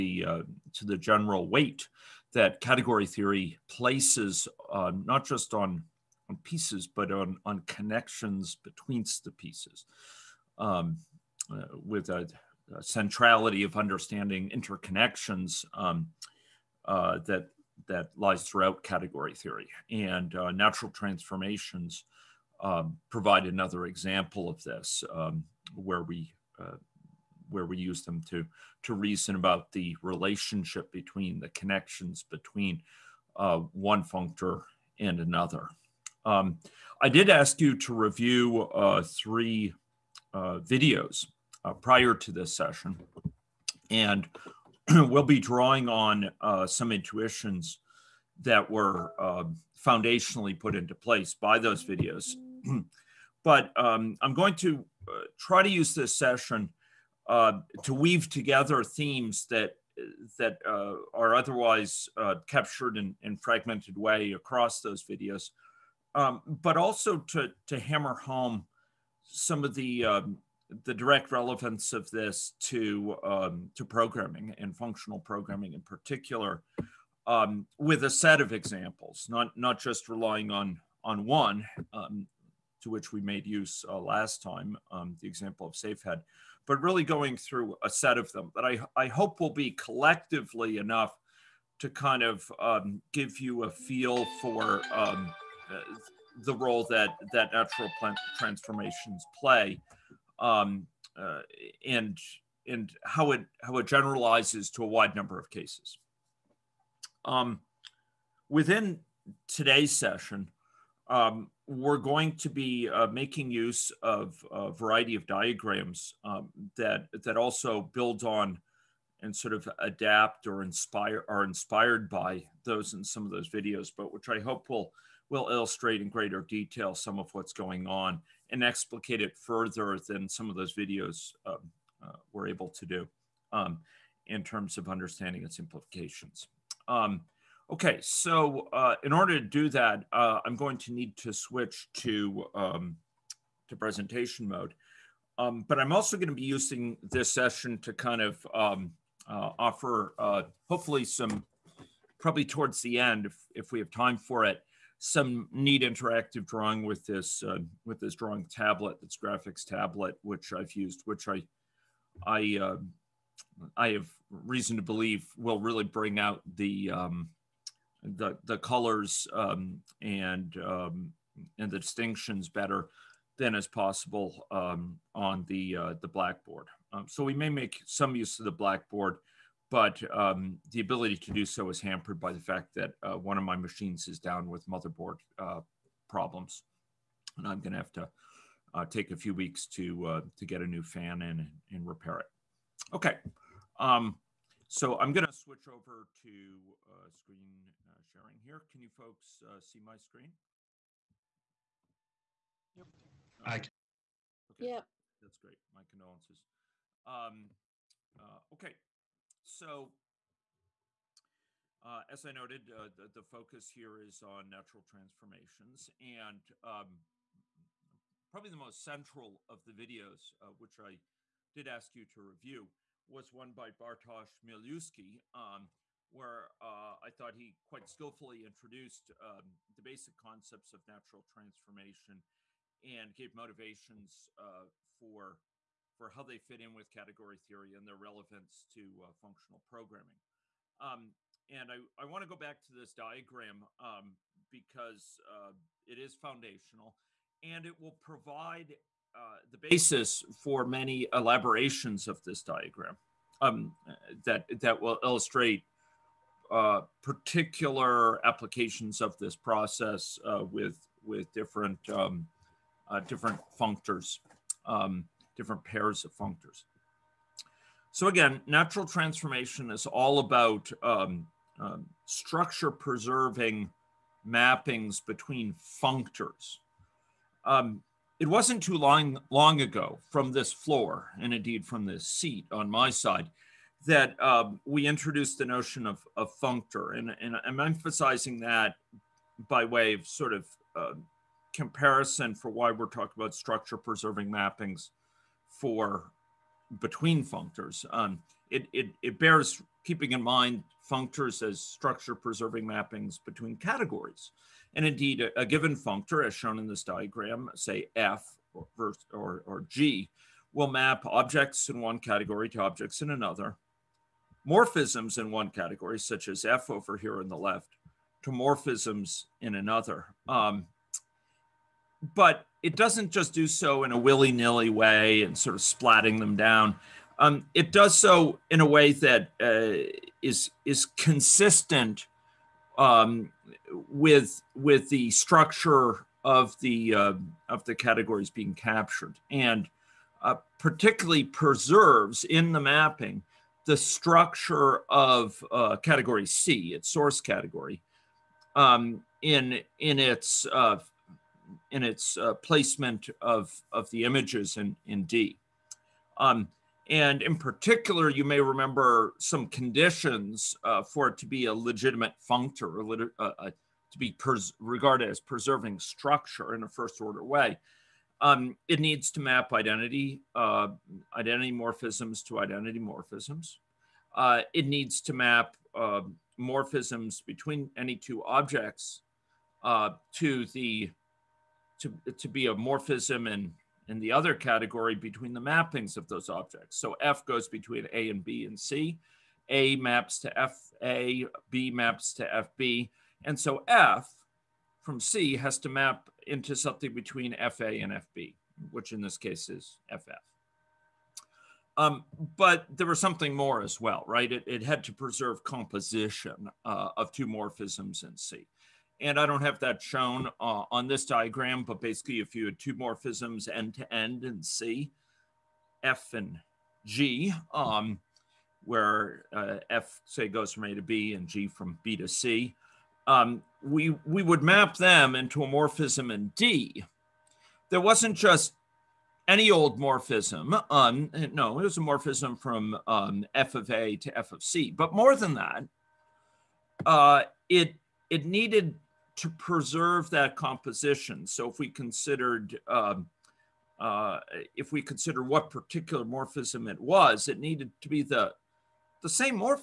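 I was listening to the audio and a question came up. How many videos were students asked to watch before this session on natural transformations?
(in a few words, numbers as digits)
3.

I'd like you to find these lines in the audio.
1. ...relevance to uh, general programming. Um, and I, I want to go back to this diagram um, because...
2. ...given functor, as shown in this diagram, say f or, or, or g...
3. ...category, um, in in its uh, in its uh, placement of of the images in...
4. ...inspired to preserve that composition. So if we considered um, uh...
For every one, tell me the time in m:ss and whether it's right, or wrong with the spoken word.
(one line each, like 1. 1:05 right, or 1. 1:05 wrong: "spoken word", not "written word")
1. 3:57 wrong: "functional", not "general"
2. 5:05 right
3. 5:47 right
4. 7:18 wrong: "needed", not "inspired".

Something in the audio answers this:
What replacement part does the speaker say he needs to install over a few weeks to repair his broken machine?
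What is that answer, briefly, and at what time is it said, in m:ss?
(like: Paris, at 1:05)
a new fan, at 3:10.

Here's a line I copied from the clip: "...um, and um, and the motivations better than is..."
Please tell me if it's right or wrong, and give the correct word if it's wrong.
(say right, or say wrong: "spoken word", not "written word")
wrong: "distinctions", not "motivations".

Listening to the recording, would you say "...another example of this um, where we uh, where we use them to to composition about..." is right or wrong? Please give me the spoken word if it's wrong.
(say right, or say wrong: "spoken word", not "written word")
wrong: "reason", not "composition".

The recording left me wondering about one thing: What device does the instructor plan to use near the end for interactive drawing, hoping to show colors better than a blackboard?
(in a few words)
graphics tablet.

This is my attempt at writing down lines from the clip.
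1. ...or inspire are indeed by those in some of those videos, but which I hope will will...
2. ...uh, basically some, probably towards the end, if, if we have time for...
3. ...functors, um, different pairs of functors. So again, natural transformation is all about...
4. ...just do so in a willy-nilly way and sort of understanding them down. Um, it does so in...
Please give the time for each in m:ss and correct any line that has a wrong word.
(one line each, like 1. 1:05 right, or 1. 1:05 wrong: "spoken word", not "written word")
1. 2:00 wrong: "inspired", not "indeed"
2. 2:30 wrong: "hopefully", not "basically"
3. 4:23 right
4. 5:23 wrong: "splatting", not "understanding".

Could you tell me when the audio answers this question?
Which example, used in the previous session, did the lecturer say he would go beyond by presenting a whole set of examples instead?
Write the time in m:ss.
1:25.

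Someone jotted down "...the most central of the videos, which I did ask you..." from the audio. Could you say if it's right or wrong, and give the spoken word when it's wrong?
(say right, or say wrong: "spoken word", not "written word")
right.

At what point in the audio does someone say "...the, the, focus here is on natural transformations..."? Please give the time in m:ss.
3:32.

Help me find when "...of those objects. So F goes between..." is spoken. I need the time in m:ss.
6:25.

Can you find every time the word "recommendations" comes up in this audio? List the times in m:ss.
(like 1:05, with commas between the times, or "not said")
not said.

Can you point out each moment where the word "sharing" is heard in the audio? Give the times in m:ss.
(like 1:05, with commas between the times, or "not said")
3:18.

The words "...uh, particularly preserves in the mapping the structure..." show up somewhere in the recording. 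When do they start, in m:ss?
5:40.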